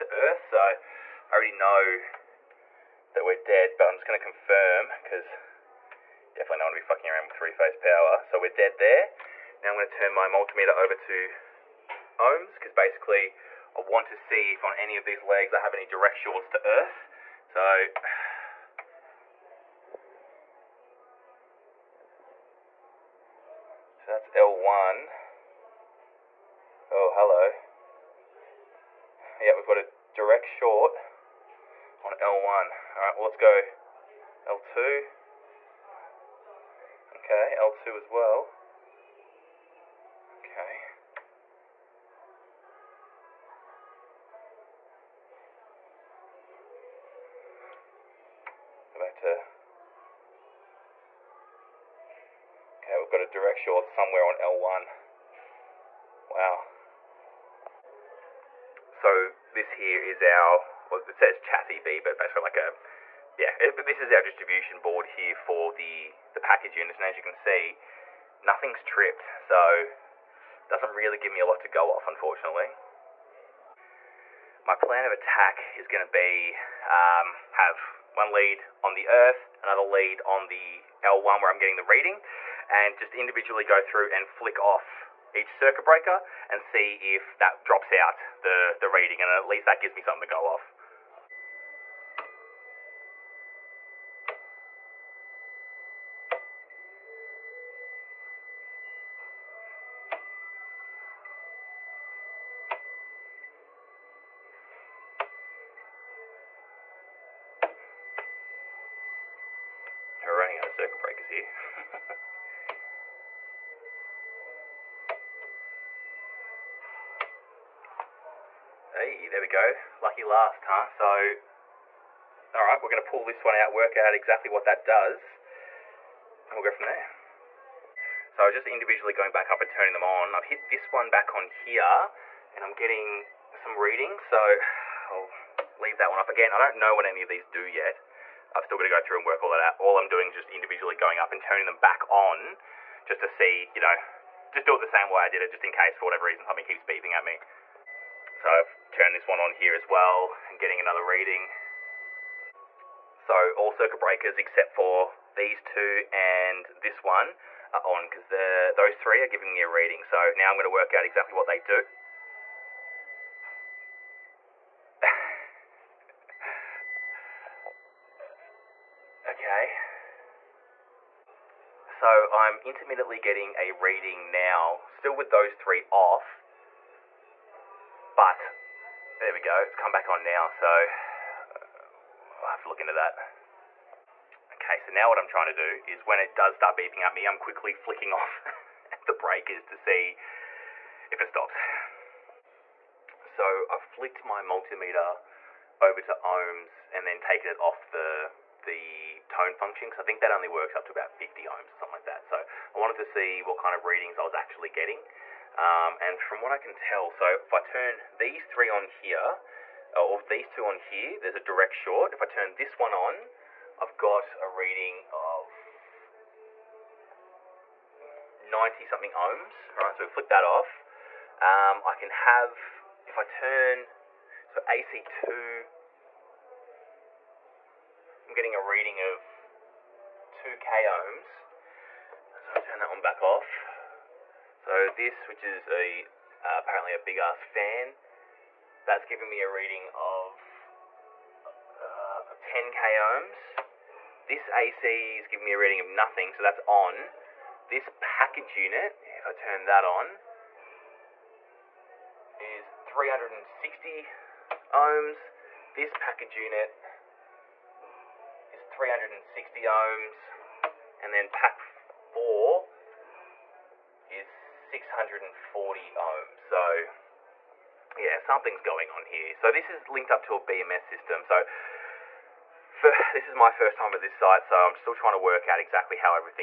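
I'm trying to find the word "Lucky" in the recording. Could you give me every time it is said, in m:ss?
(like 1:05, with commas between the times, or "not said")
1:59.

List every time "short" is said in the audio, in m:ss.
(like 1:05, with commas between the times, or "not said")
0:16, 0:30, 0:53, 3:31.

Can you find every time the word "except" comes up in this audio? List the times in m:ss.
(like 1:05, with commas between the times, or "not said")
2:34.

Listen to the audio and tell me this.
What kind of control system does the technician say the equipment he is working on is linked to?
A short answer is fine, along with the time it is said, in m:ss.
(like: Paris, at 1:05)
BMS system, at 4:30.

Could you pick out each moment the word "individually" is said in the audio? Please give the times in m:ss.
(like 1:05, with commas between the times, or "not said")
1:23, 2:08, 2:20.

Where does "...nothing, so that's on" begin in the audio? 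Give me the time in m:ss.
4:05.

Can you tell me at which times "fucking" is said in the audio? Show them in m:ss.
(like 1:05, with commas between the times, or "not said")
0:06.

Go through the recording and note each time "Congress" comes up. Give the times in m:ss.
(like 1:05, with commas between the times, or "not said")
not said.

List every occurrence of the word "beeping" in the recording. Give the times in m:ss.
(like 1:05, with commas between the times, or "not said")
2:26, 3:06.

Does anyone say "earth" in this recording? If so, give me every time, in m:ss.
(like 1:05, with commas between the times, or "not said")
0:00, 0:16, 1:19.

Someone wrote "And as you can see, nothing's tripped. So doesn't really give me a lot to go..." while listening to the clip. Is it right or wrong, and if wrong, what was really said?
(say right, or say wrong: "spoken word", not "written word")
right.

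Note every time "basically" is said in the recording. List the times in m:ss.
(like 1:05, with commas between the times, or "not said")
0:12, 1:02.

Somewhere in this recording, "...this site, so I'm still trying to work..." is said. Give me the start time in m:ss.
4:33.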